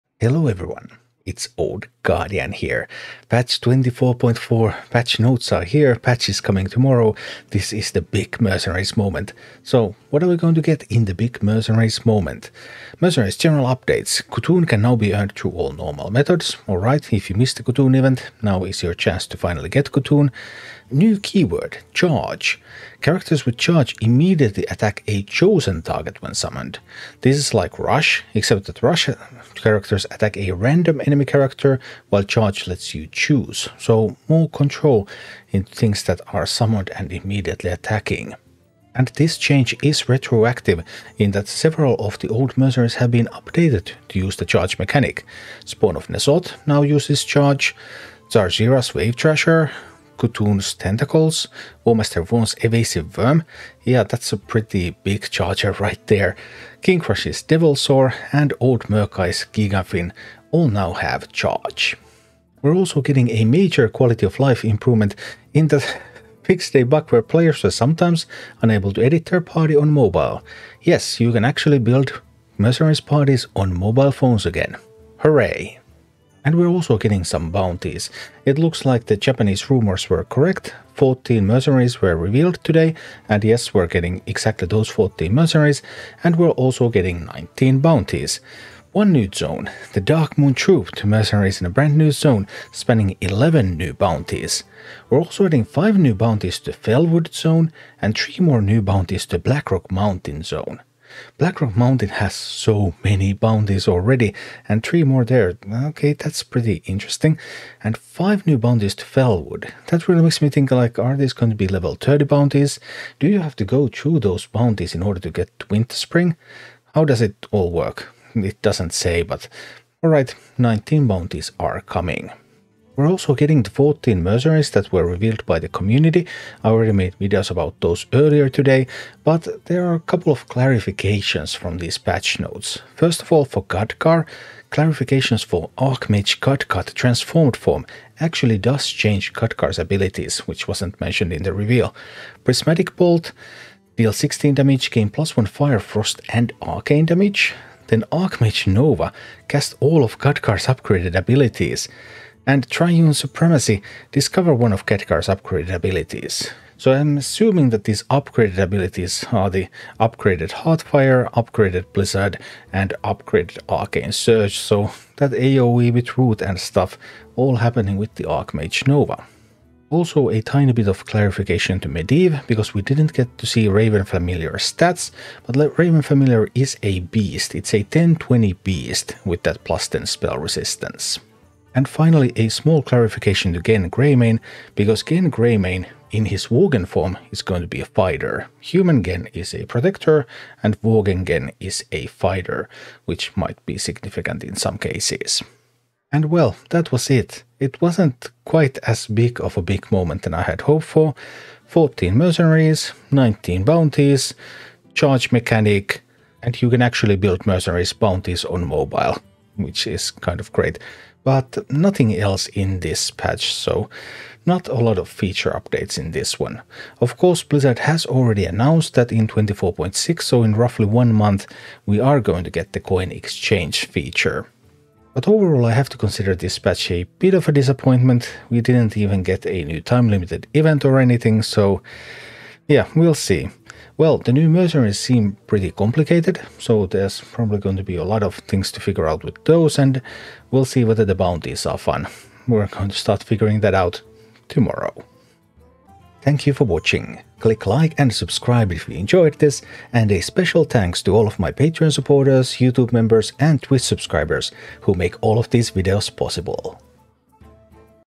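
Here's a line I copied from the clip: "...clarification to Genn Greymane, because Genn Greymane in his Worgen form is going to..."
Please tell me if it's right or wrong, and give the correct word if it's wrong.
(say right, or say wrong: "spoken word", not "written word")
right.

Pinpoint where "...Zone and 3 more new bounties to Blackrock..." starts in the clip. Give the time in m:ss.
1:37.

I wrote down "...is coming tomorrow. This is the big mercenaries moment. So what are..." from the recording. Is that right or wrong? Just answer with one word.
right.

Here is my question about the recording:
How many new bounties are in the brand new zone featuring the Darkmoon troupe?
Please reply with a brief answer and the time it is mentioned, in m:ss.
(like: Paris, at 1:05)
11, at 1:33.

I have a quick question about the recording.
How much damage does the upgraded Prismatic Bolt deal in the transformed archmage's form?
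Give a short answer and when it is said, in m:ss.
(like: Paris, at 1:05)
16, at 2:24.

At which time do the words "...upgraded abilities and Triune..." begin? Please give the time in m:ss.
2:30.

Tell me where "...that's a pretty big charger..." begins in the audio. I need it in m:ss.
0:54.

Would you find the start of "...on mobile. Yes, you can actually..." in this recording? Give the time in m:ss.
1:09.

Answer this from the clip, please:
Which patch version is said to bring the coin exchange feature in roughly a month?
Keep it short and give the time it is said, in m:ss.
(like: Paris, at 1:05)
24.6, at 3:39.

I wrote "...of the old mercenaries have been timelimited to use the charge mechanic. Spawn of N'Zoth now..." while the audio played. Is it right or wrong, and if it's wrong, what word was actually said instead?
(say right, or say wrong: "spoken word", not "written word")
wrong: "updated", not "timelimited".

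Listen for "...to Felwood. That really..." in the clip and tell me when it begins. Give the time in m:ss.
1:48.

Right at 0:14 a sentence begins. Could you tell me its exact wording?
C'Thun can now be earned through all normal methods.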